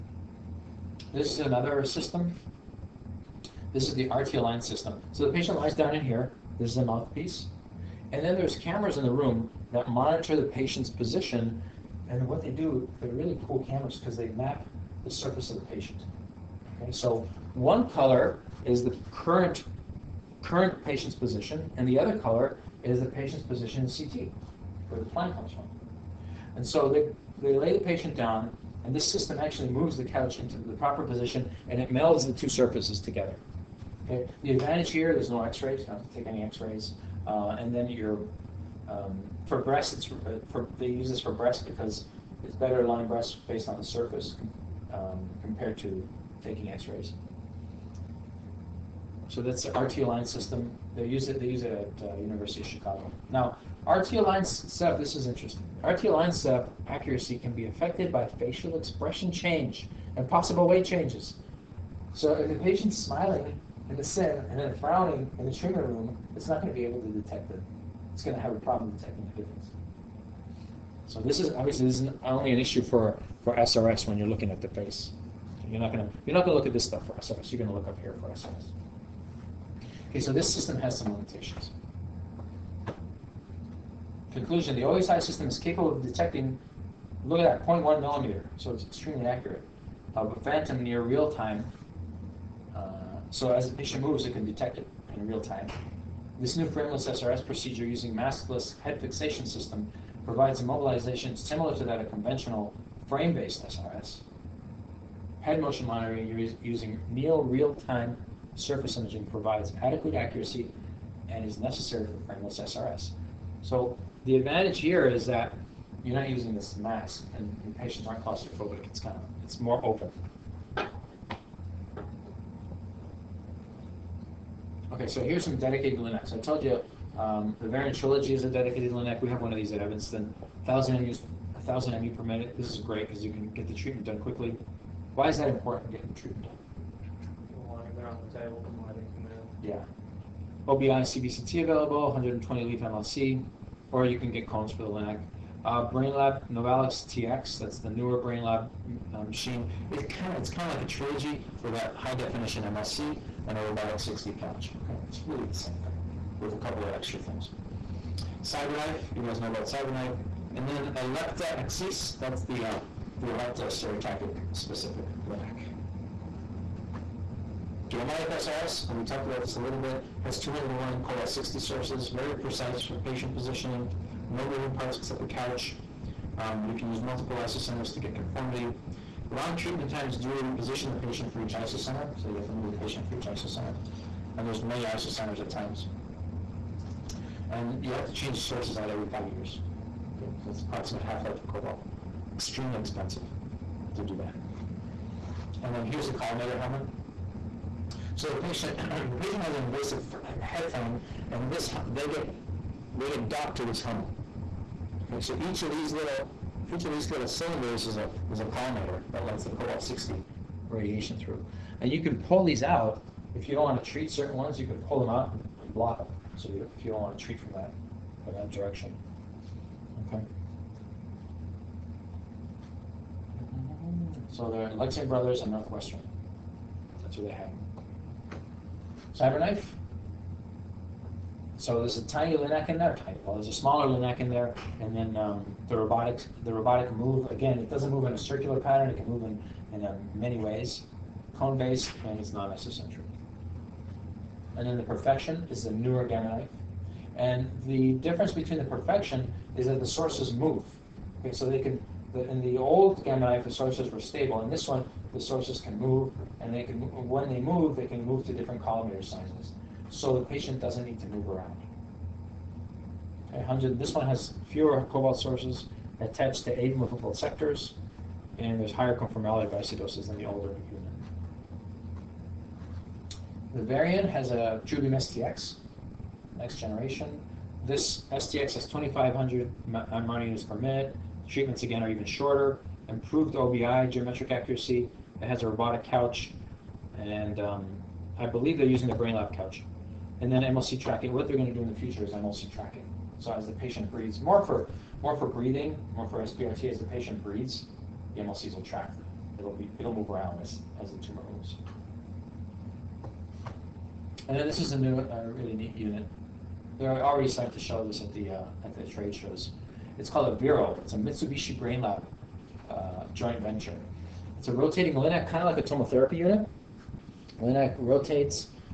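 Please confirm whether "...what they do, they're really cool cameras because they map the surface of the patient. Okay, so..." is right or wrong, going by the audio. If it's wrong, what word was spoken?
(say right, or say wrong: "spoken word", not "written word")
right.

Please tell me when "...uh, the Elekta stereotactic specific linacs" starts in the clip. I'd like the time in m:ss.
2:42.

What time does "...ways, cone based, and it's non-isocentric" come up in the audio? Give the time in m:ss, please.
4:00.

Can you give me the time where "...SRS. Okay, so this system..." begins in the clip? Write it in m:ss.
1:18.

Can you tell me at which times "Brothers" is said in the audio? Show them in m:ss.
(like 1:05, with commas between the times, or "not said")
3:45.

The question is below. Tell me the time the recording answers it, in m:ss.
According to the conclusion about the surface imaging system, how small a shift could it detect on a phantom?
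1:27.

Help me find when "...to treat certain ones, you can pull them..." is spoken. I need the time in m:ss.
3:33.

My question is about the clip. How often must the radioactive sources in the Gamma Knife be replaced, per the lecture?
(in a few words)
every five years.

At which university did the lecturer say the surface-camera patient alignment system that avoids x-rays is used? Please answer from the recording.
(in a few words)
University of Chicago.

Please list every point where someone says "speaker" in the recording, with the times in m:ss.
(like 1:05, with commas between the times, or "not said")
not said.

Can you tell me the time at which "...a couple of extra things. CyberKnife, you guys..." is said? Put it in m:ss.
2:36.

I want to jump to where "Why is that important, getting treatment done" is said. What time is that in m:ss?
2:15.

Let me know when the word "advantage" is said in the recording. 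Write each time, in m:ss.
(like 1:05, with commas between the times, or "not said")
0:34, 1:54.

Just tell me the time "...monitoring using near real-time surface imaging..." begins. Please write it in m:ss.
1:45.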